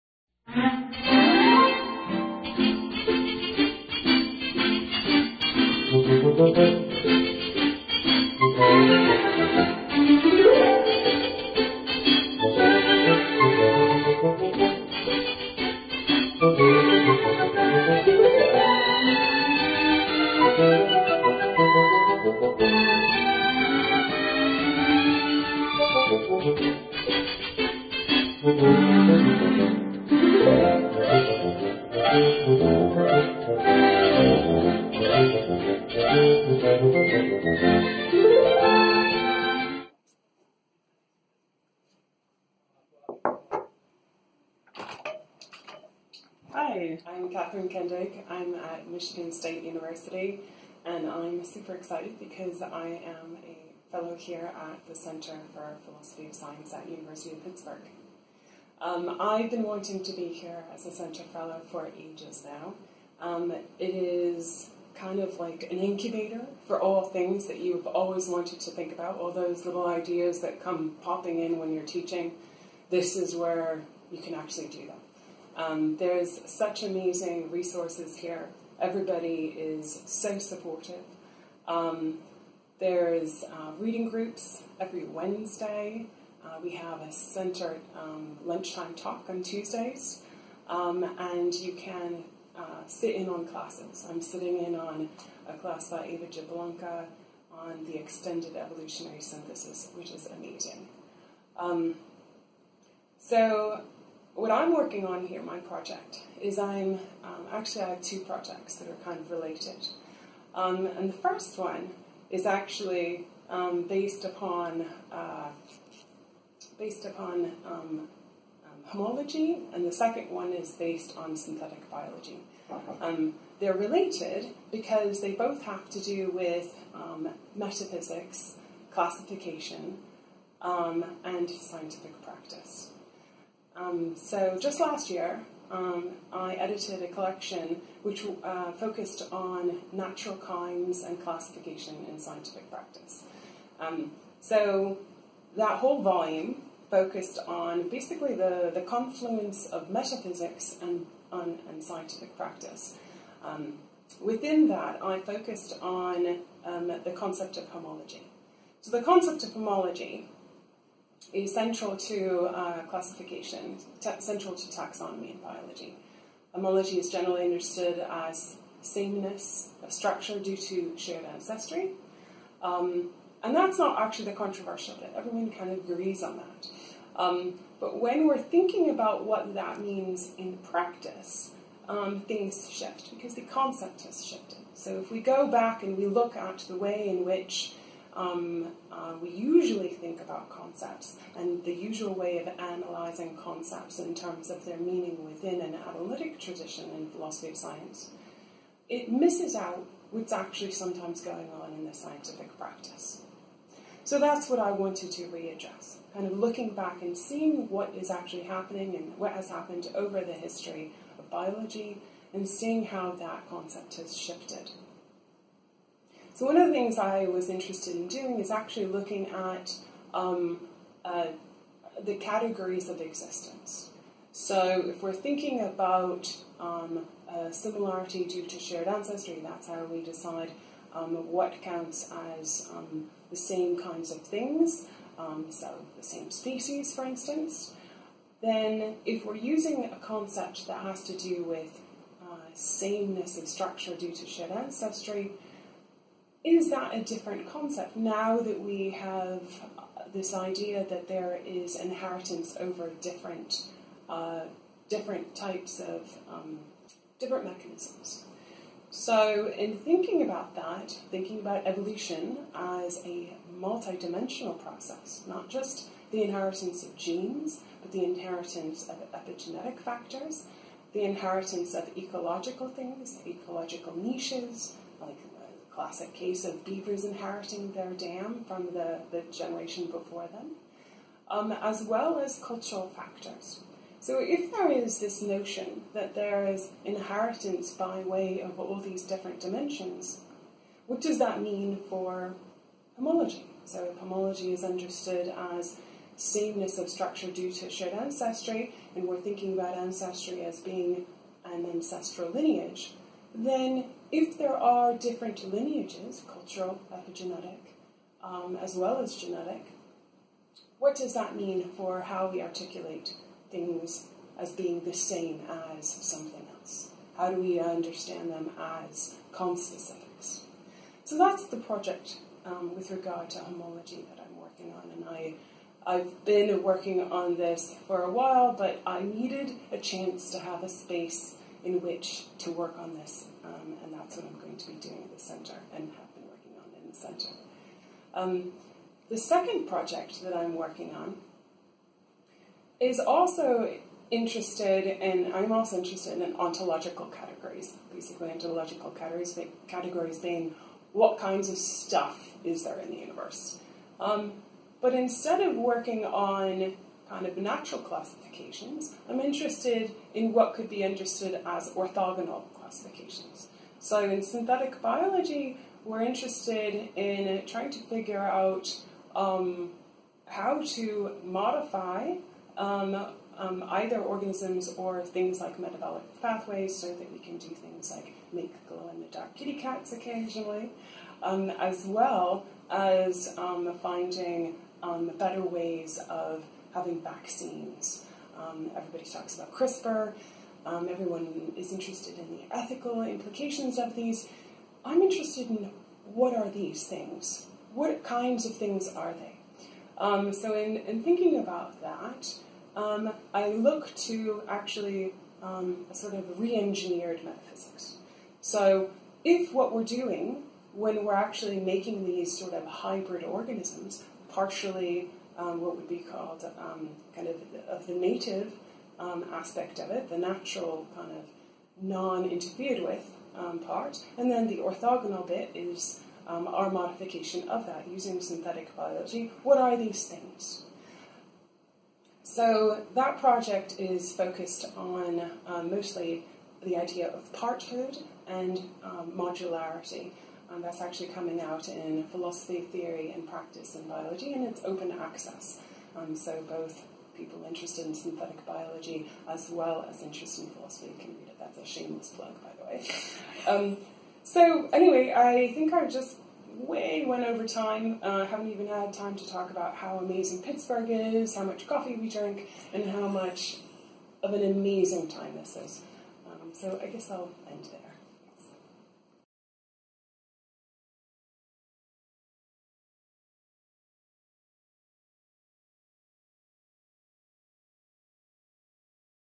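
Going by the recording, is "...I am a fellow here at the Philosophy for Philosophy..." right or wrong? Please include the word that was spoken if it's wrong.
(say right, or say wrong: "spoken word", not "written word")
wrong: "Center", not "Philosophy".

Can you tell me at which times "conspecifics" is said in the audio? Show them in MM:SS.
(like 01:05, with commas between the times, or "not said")
05:19.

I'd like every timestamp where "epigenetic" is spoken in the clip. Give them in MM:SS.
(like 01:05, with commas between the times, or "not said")
04:29, 05:06.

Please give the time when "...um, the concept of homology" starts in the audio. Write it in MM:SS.
02:36.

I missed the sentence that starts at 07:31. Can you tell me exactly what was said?
That's a shameless plug, by the way.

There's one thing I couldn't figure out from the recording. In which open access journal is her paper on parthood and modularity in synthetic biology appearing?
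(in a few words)
Philosophy, Theory, and Practice in Biology.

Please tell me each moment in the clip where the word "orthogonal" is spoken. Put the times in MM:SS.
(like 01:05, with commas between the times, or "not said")
06:01, 07:04.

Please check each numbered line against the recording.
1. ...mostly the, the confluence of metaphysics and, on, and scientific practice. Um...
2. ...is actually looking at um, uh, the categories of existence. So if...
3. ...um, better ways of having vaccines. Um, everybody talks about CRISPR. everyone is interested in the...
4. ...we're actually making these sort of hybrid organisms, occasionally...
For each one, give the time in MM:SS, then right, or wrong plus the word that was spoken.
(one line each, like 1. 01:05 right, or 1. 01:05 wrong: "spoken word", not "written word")
1. 02:27 wrong: "basically", not "mostly"
2. 03:38 right
3. 06:24 right
4. 06:51 wrong: "partially", not "occasionally".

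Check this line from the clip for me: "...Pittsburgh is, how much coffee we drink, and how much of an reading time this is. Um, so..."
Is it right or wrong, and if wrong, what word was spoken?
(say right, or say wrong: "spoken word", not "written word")
wrong: "amazing", not "reading".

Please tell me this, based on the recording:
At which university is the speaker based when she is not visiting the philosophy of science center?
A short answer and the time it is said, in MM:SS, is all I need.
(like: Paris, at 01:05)
Michigan State University, at 00:48.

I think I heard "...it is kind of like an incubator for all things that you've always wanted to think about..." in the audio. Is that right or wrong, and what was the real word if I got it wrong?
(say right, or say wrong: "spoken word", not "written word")
right.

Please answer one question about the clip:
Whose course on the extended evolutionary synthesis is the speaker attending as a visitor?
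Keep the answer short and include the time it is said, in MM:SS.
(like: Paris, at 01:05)
Eva Jablonka, at 01:36.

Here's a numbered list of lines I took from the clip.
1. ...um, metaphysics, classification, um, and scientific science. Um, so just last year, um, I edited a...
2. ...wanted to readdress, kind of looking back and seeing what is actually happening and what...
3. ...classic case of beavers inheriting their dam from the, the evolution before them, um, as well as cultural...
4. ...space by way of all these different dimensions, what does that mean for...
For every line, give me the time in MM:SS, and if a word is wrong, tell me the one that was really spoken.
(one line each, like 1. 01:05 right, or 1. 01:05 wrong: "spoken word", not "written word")
1. 02:06 wrong: "practice", not "science"
2. 03:24 right
3. 04:35 wrong: "generation", not "evolution"
4. 04:46 wrong: "inheritance", not "space".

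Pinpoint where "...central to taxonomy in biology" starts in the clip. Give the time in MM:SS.
02:44.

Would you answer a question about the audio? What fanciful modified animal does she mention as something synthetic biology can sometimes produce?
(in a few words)
Glow in the dark kitty cats.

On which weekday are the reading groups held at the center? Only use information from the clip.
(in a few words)
Wednesday.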